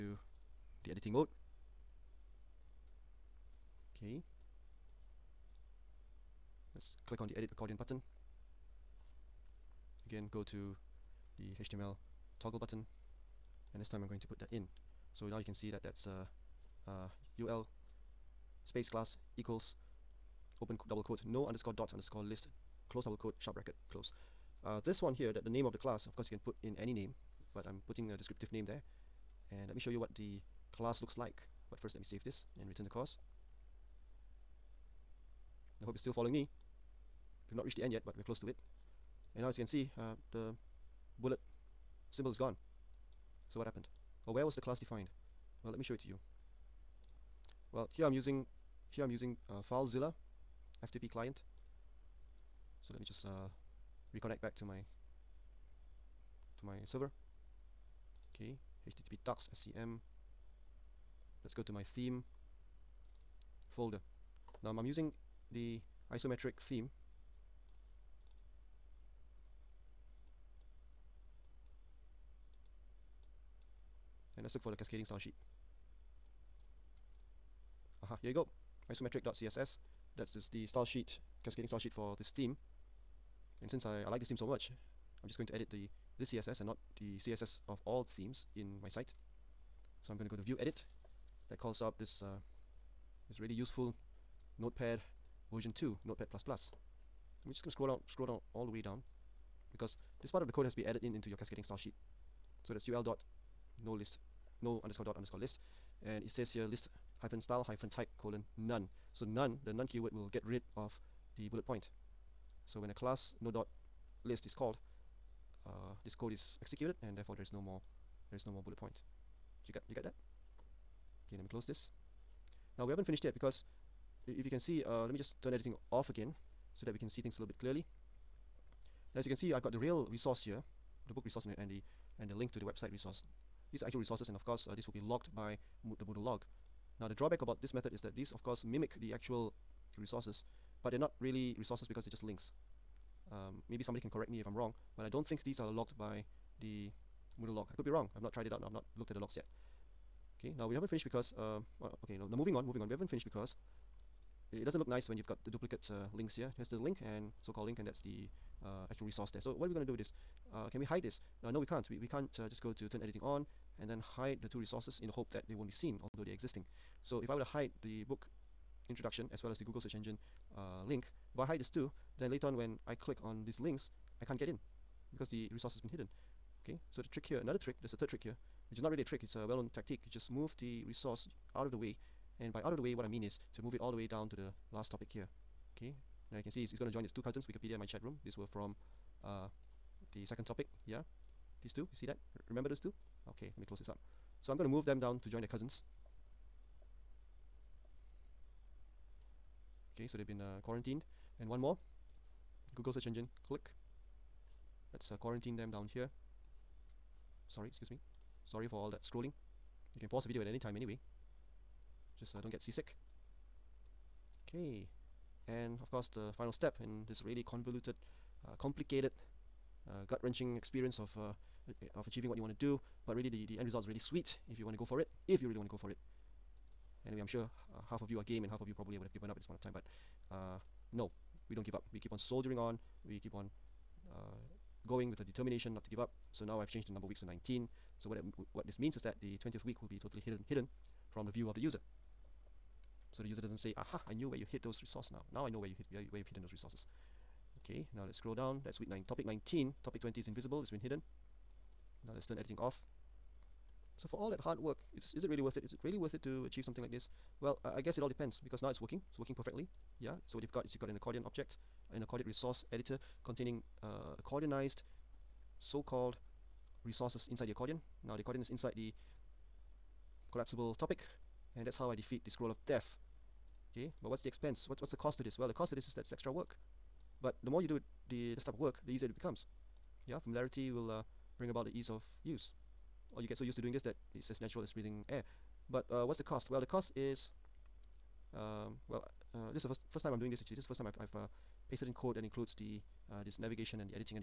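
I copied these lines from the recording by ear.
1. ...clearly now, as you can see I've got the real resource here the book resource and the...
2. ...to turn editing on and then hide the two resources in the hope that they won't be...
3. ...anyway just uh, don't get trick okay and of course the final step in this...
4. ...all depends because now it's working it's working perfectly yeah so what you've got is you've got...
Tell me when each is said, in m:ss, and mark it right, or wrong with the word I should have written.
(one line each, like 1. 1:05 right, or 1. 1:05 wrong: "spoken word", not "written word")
1. 2:07 right
2. 2:42 right
3. 3:30 wrong: "seasick", not "trick"
4. 4:18 right.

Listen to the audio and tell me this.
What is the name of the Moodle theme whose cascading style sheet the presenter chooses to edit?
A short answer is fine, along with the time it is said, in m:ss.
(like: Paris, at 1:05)
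isometric, at 1:06.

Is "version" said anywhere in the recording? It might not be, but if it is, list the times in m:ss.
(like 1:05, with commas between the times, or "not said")
1:35.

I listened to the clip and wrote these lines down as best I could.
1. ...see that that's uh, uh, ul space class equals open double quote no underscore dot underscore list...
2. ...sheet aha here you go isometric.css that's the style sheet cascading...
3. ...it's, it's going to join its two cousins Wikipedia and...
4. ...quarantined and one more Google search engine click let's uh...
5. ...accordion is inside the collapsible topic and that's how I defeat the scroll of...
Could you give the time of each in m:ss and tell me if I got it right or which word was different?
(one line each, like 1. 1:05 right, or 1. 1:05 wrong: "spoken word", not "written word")
1. 0:15 right
2. 1:15 right
3. 3:06 right
4. 3:20 right
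5. 4:28 right.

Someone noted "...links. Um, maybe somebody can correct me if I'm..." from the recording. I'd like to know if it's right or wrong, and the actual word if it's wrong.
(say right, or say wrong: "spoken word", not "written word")
right.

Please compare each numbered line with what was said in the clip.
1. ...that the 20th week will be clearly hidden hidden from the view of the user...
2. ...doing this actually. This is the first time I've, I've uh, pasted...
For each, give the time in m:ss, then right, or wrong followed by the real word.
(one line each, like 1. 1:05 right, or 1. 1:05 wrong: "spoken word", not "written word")
1. 3:59 wrong: "totally", not "clearly"
2. 4:50 right.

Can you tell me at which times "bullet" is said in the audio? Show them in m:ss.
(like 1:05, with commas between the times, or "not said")
0:41, 1:51, 1:58.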